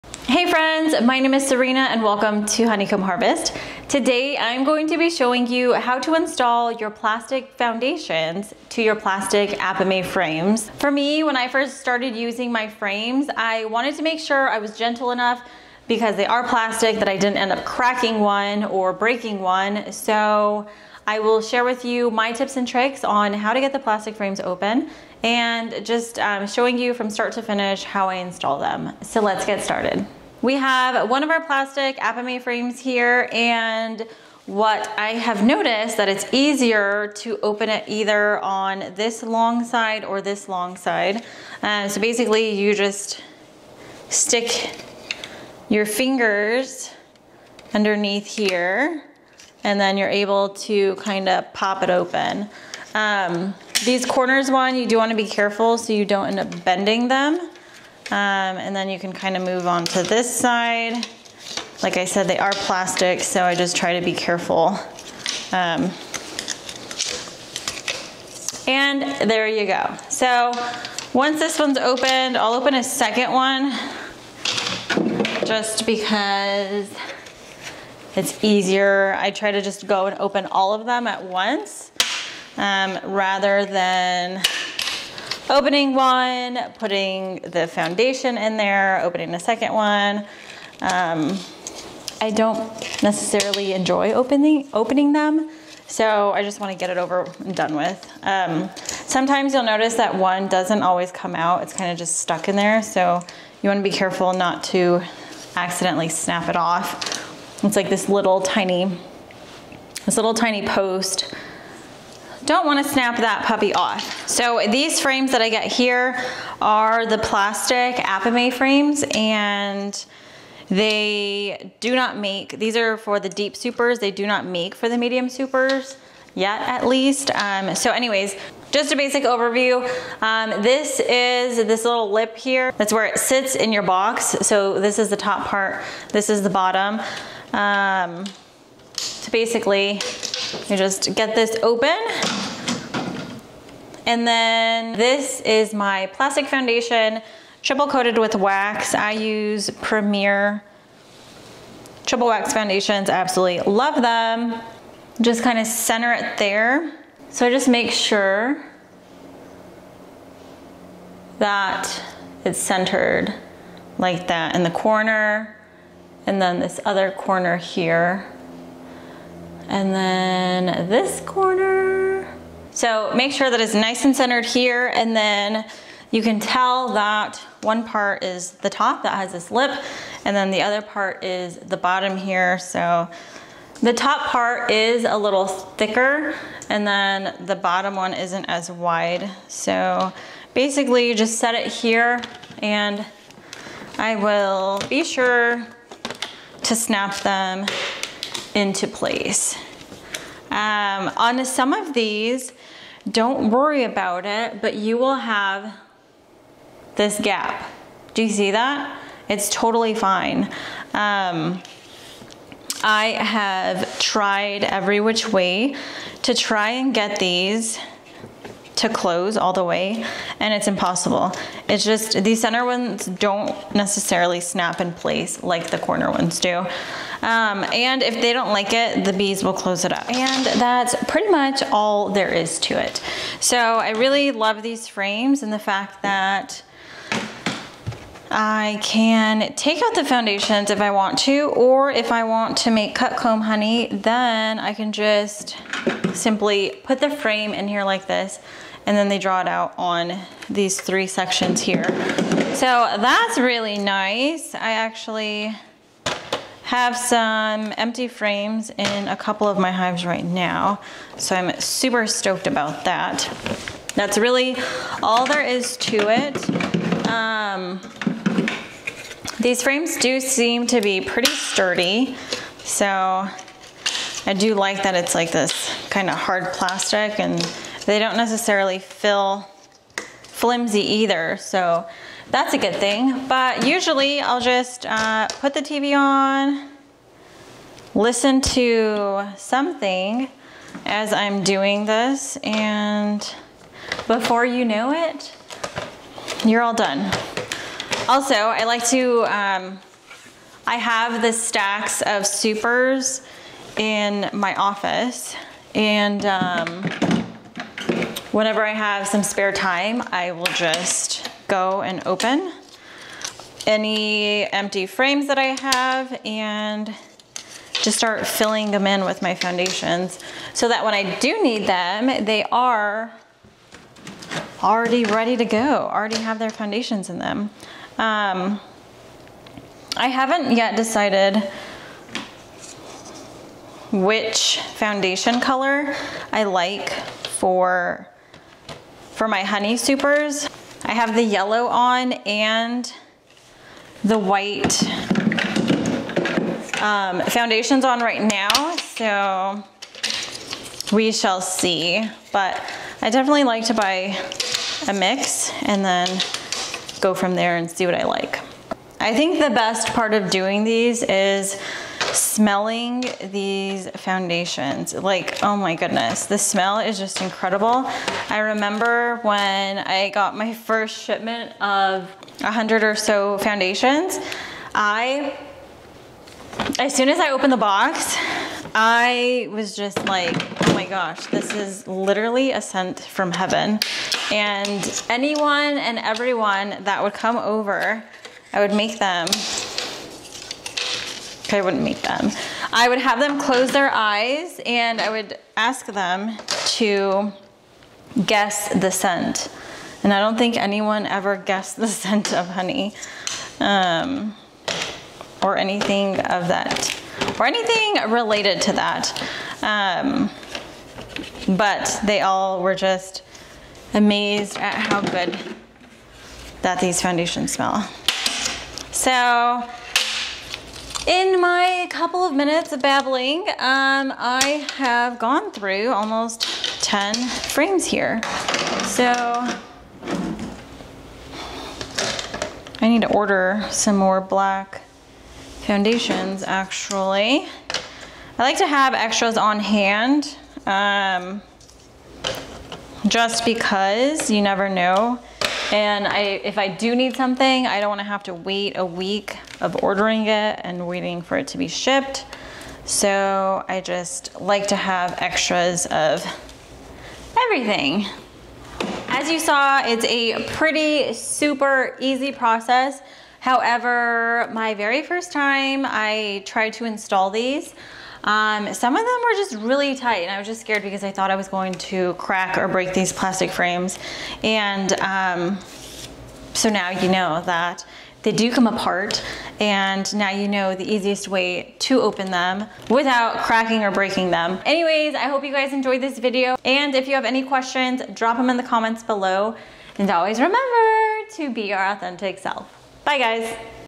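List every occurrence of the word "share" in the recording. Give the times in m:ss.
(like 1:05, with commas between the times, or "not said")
0:21.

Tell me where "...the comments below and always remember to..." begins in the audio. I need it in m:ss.
8:08.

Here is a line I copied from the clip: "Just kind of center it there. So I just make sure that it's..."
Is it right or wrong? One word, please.
right.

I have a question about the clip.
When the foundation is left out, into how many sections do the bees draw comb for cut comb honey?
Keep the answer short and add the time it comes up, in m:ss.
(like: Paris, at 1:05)
3, at 4:10.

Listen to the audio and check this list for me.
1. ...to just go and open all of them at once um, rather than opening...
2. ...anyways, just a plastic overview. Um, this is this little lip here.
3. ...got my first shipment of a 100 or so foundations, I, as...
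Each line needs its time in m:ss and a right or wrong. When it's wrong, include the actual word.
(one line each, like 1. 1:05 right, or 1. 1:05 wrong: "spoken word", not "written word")
1. 1:19 right
2. 2:07 wrong: "basic", not "plastic"
3. 6:10 right.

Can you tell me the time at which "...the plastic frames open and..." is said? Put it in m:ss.
0:23.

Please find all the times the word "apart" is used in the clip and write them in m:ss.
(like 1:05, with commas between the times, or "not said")
7:58.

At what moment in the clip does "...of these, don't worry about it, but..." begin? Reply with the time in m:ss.
3:21.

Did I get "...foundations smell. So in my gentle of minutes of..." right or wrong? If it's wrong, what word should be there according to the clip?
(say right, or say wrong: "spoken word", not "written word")
wrong: "couple", not "gentle".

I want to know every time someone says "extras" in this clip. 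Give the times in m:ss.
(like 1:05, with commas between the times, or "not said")
7:18, 7:35.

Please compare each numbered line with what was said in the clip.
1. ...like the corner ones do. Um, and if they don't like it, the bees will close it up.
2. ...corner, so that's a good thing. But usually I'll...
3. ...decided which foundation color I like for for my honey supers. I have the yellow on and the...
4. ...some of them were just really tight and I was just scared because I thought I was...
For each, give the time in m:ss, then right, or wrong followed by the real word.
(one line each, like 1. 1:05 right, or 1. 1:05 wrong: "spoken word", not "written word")
1. 3:45 right
2. 4:40 wrong: "either", not "corner"
3. 5:30 right
4. 7:48 right.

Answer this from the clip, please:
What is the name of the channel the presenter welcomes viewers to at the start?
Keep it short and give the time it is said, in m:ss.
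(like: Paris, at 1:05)
Honeycomb Harvest, at 0:02.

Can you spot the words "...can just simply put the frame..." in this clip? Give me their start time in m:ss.
4:04.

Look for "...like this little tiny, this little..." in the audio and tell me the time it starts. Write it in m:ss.
1:47.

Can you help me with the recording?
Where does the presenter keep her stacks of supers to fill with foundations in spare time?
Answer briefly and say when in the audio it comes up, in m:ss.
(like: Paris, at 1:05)
office, at 5:04.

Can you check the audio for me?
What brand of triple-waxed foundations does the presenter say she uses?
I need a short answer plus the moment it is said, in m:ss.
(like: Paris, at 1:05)
Premier, at 2:29.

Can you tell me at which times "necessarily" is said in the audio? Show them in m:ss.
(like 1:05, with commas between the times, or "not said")
1:33, 3:43, 4:38.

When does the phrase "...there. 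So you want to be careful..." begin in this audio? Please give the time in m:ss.
1:42.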